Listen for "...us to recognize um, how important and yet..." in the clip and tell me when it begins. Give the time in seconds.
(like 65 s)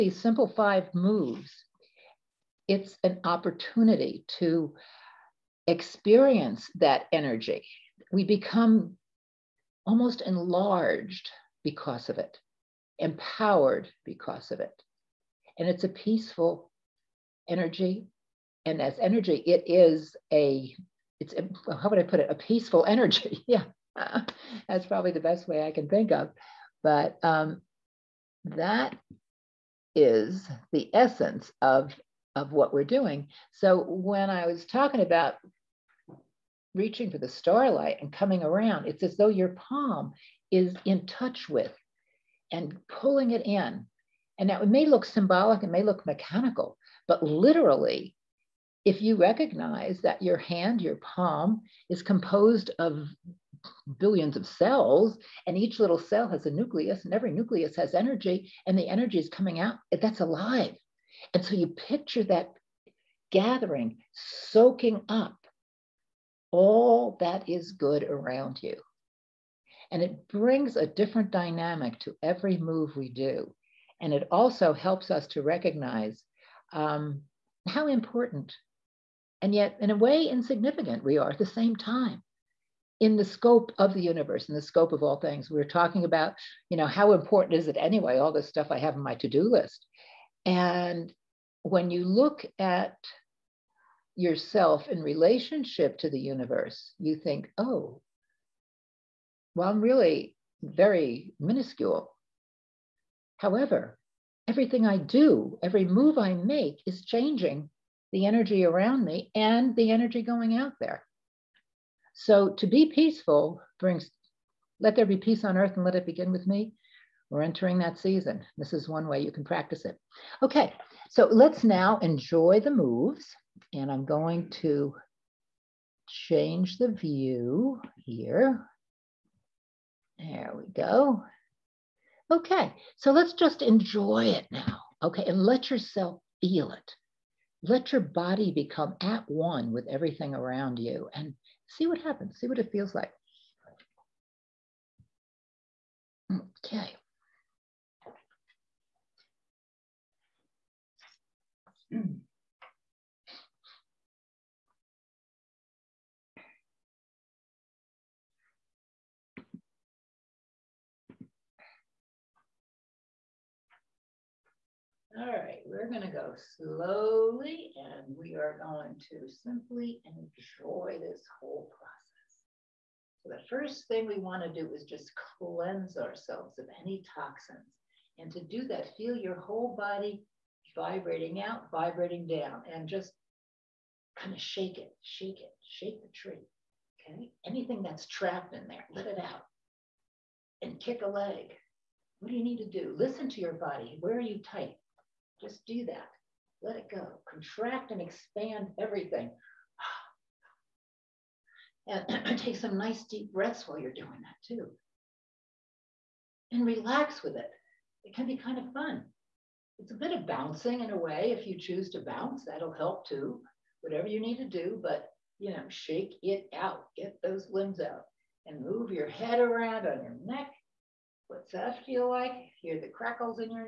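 75 s.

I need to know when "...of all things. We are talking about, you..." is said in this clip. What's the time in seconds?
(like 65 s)
84 s.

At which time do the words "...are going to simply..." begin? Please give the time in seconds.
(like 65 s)
168 s.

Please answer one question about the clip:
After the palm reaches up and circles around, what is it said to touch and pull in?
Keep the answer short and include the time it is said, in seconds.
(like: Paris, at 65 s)
starlight, at 37 s.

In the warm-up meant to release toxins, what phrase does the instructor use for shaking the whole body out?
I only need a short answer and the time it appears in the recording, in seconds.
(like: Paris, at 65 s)
shake the tree, at 185 s.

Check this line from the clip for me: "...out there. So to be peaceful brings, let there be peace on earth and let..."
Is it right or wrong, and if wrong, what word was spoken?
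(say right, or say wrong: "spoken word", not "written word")
right.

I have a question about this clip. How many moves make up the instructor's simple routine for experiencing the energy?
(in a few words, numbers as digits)
5.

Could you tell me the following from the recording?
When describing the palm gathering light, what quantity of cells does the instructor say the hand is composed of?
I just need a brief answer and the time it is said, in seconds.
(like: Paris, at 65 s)
billions, at 53 s.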